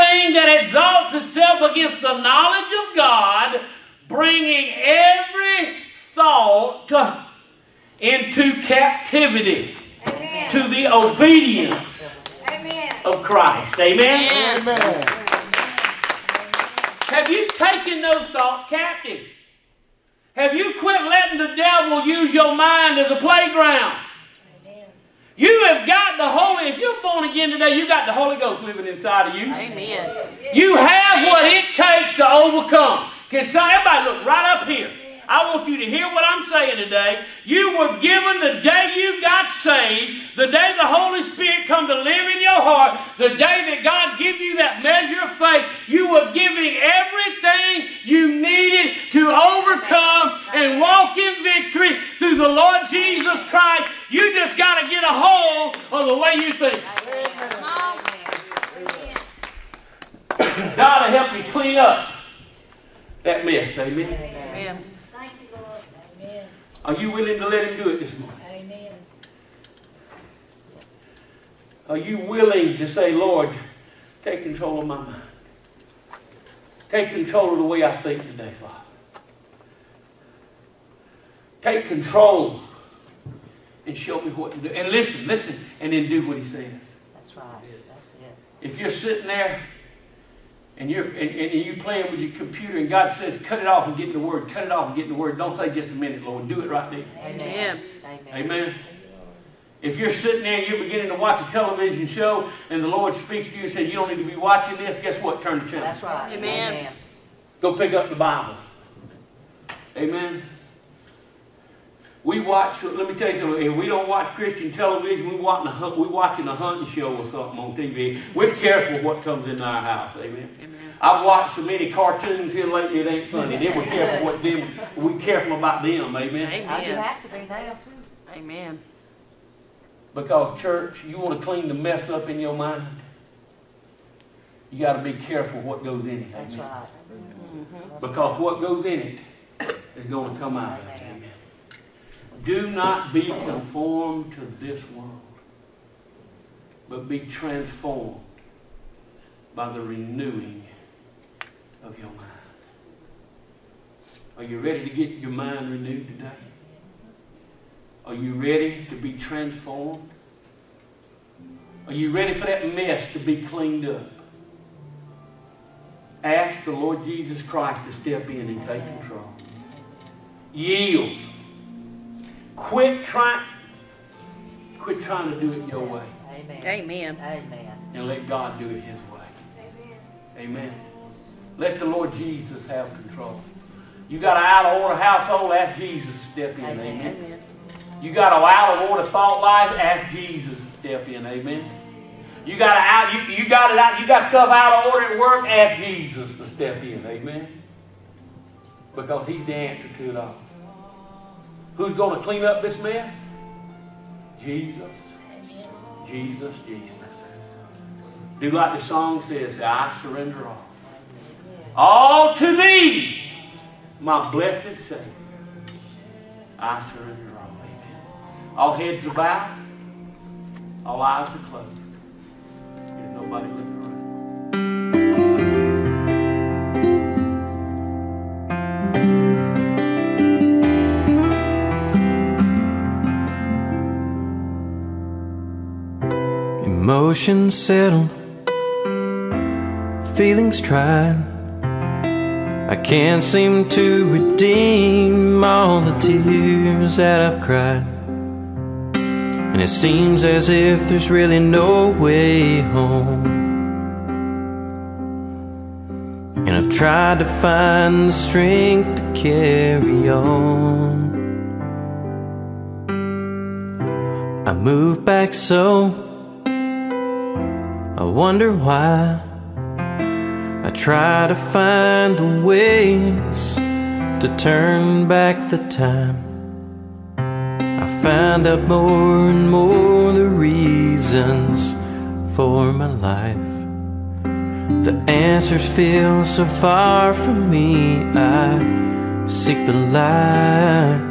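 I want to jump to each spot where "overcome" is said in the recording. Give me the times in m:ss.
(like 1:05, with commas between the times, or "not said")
0:32, 0:49.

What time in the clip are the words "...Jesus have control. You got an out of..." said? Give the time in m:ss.
3:02.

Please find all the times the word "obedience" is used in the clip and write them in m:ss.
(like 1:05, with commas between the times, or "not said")
0:10.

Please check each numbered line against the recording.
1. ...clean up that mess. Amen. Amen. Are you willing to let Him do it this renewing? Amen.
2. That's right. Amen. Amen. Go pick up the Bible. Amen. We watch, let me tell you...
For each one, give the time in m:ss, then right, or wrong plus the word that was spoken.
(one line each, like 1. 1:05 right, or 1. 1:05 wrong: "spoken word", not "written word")
1. 1:01 wrong: "morning", not "renewing"
2. 1:45 right.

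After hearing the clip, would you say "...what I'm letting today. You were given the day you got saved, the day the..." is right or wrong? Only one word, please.
wrong.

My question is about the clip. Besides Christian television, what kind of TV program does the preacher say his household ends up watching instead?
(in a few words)
a hunting show.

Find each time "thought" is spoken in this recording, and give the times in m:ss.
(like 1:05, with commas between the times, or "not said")
0:06, 0:18, 3:09.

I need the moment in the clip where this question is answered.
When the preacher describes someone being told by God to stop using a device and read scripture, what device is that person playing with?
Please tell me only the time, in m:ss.
1:32.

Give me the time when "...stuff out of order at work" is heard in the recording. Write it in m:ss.
3:14.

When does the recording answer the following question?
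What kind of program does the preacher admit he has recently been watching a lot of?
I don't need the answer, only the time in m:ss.
2:01.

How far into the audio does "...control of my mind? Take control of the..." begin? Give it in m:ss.
1:14.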